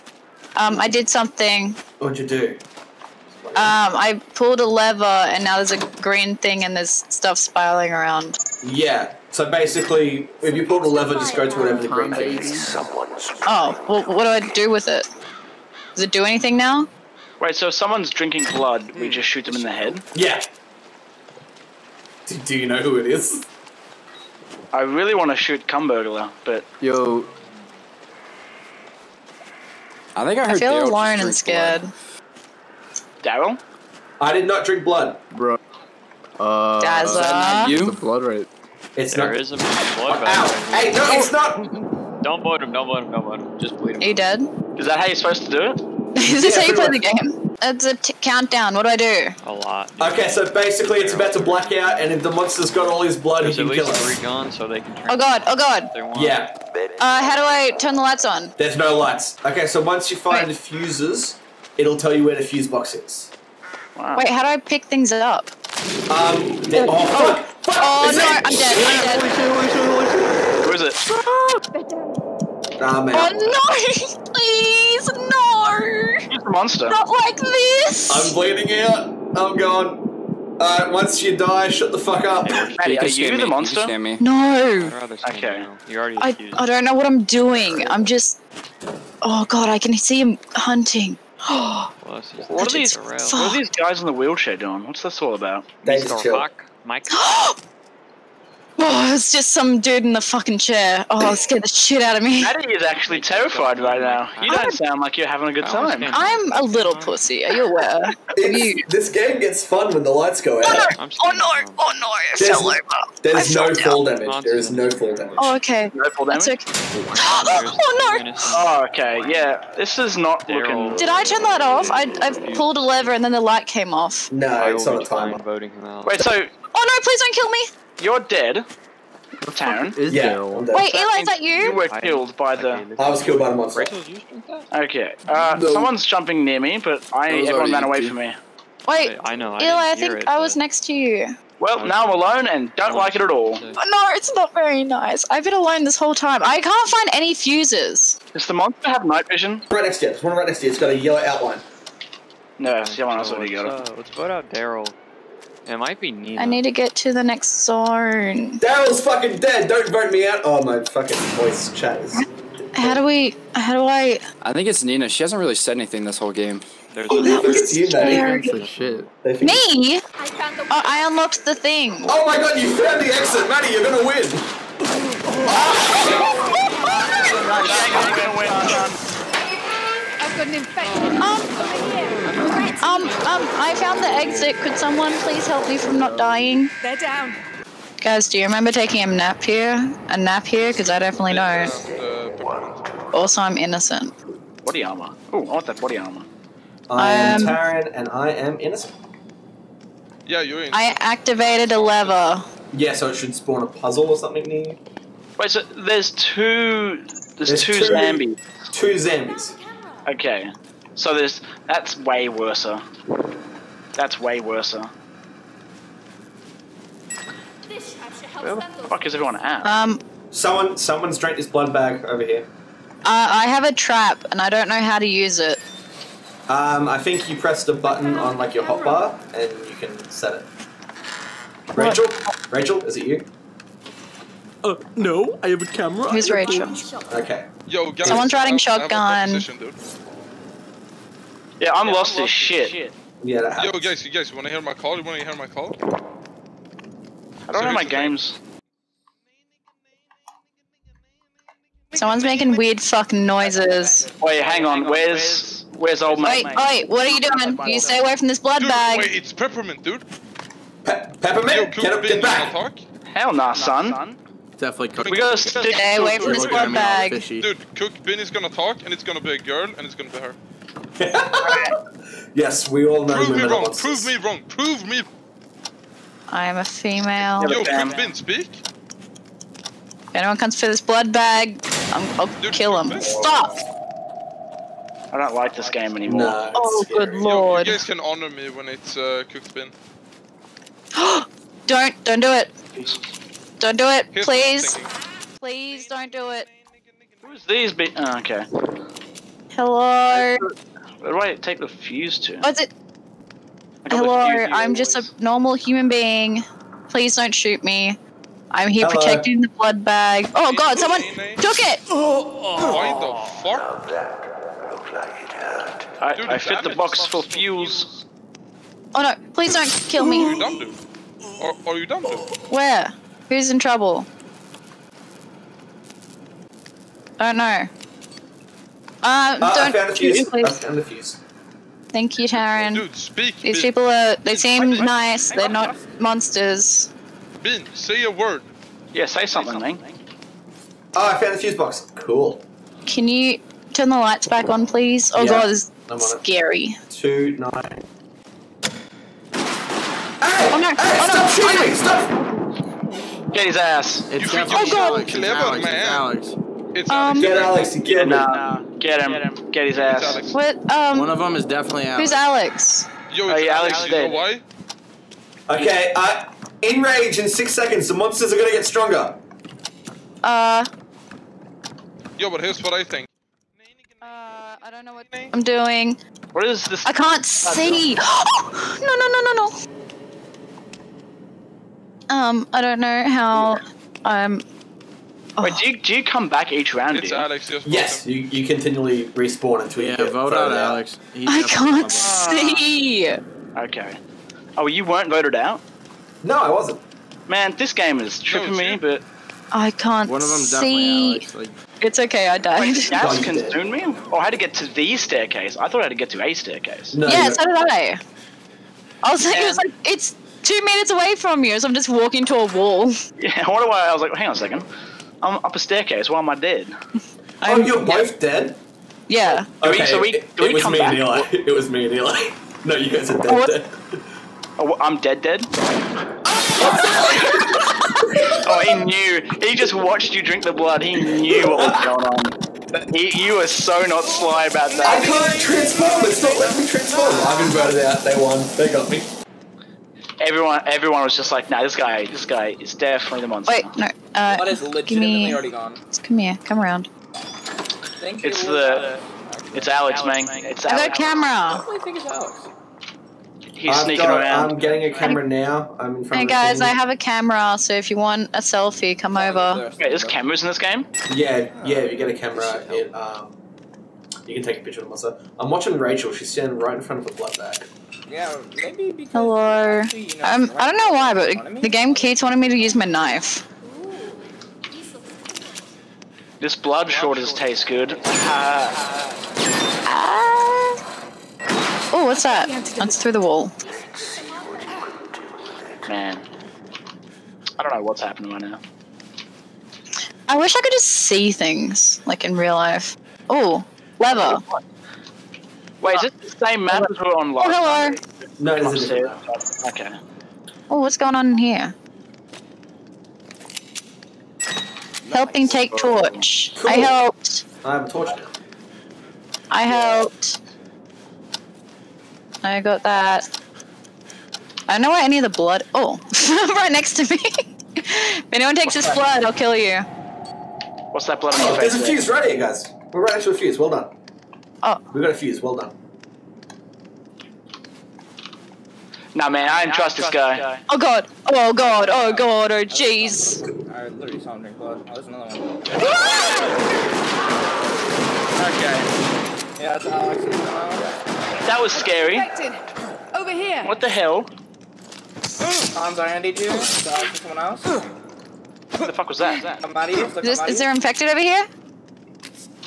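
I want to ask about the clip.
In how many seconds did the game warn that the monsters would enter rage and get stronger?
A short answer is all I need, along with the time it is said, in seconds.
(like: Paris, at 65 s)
6, at 366 s.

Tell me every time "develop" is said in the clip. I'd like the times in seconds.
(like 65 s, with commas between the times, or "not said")
not said.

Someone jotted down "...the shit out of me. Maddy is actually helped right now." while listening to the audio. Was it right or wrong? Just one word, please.
wrong.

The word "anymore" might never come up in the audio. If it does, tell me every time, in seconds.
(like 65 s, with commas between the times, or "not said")
285 s.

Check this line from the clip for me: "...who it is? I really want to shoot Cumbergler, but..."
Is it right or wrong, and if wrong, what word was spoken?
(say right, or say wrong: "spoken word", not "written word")
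right.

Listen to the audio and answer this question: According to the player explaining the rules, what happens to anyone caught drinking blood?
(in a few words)
Shoot them in the head.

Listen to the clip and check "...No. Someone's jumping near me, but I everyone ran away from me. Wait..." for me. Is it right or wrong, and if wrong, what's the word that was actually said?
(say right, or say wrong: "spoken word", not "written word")
right.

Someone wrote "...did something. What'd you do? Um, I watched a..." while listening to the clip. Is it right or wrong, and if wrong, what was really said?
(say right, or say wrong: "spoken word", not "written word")
wrong: "pulled", not "watched".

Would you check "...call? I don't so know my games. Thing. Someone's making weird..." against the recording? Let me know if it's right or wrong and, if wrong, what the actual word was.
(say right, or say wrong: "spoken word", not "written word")
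right.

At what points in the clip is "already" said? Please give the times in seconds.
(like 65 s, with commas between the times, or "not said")
85 s, 153 s, 445 s.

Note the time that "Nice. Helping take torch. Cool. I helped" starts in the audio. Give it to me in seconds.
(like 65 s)
504 s.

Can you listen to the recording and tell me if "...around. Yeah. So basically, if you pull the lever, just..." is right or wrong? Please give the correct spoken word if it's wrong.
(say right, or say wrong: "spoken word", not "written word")
right.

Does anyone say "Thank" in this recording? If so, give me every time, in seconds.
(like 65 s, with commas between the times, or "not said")
331 s, 447 s.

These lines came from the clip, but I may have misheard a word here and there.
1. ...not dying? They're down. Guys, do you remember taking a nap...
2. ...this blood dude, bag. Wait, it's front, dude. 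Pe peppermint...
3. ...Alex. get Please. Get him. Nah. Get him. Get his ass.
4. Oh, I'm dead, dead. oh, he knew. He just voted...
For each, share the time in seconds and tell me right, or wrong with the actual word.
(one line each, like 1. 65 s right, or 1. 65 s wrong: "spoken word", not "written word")
1. 185 s right
2. 258 s wrong: "peppermint", not "front"
3. 357 s wrong: "Alex", not "Please"
4. 424 s wrong: "watched", not "voted".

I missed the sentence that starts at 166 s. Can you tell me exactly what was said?
There's oh, that was you, shit.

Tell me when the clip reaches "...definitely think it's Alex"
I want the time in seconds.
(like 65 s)
451 s.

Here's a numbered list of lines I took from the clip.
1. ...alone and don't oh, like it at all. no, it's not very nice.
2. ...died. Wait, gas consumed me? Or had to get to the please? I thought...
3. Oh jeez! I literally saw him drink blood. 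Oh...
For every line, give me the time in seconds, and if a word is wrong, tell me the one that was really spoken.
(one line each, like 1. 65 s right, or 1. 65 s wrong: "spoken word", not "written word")
1. 142 s right
2. 402 s wrong: "staircase", not "please"
3. 532 s right.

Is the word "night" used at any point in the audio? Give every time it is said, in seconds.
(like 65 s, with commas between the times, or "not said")
149 s.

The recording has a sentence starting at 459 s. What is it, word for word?
Wait, there's cameras in this game?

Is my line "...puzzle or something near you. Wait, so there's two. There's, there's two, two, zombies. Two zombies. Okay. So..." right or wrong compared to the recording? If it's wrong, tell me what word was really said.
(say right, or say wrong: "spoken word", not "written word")
right.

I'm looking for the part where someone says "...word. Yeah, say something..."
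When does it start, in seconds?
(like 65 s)
338 s.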